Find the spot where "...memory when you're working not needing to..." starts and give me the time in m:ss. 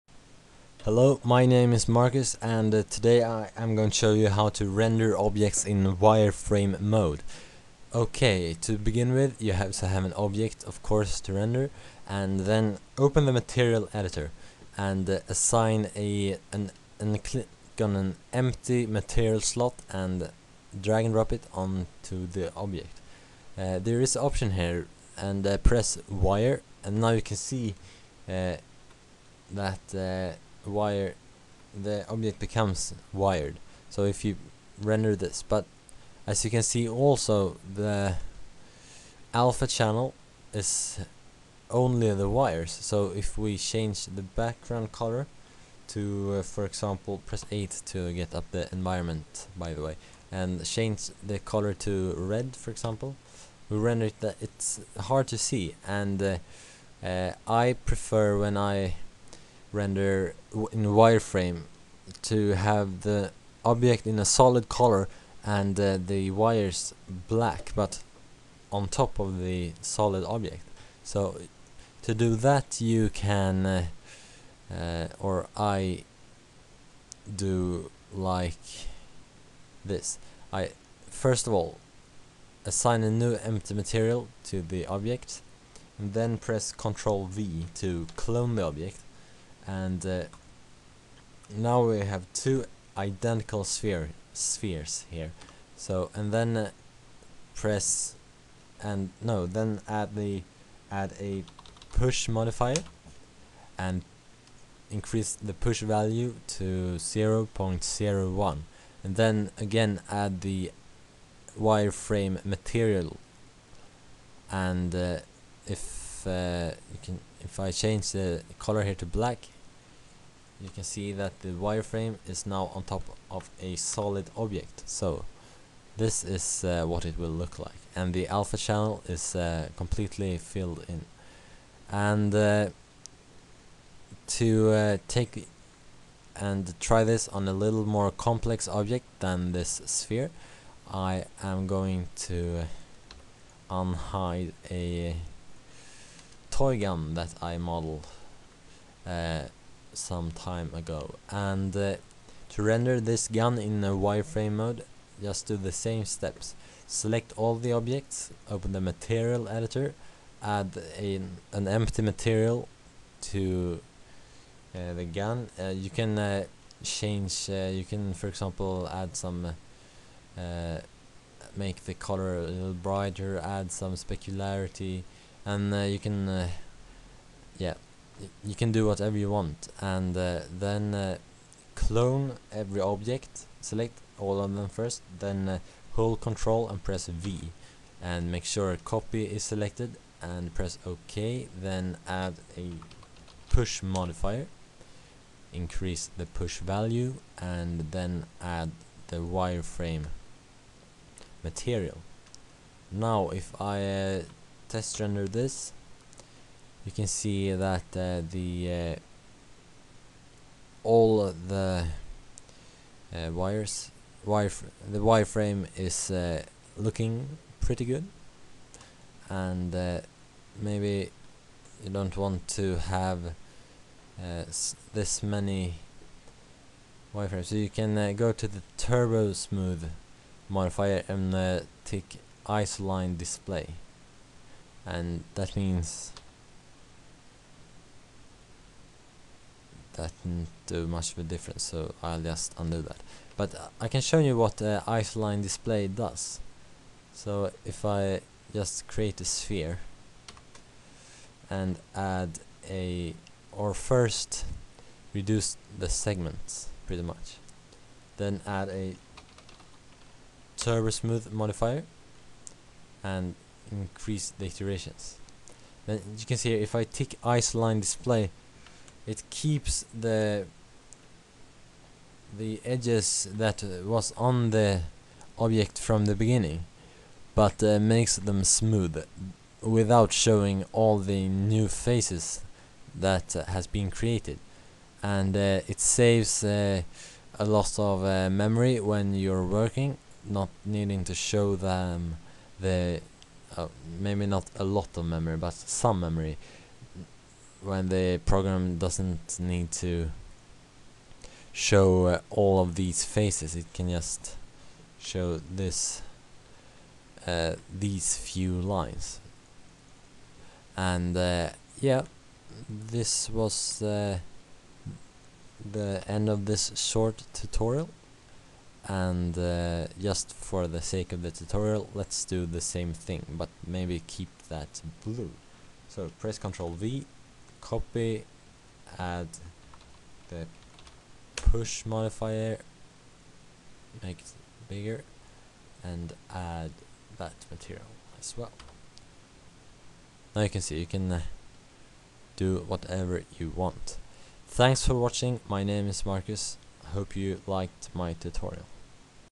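4:48.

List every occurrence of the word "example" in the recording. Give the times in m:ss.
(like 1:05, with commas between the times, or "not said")
0:46, 0:52, 2:48.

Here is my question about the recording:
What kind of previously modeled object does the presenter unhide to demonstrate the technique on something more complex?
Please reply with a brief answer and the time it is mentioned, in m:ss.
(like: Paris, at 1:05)
Toy gun, at 2:26.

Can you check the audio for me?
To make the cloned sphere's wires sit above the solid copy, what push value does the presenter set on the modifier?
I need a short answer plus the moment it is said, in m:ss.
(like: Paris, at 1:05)
0.01, at 1:46.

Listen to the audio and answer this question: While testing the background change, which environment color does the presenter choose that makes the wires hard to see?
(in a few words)
Red.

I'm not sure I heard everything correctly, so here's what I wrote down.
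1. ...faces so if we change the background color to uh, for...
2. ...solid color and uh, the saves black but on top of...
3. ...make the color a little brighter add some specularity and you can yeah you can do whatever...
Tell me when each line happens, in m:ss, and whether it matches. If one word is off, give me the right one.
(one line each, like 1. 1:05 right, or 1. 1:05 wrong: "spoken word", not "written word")
1. 0:42 wrong: "wires", not "faces"
2. 1:04 wrong: "wires", not "saves"
3. 2:51 right.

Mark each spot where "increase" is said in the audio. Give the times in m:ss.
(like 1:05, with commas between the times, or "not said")
1:44, 3:15, 4:23.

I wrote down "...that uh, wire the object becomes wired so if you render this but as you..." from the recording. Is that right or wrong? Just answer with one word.
right.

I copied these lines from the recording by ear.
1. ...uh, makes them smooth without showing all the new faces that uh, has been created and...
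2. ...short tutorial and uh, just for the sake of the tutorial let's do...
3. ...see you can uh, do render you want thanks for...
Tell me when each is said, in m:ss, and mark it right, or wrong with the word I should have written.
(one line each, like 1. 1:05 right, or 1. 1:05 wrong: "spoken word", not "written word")
1. 4:37 right
2. 5:16 right
3. 5:40 wrong: "whatever", not "render".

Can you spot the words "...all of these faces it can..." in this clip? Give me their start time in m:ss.
5:02.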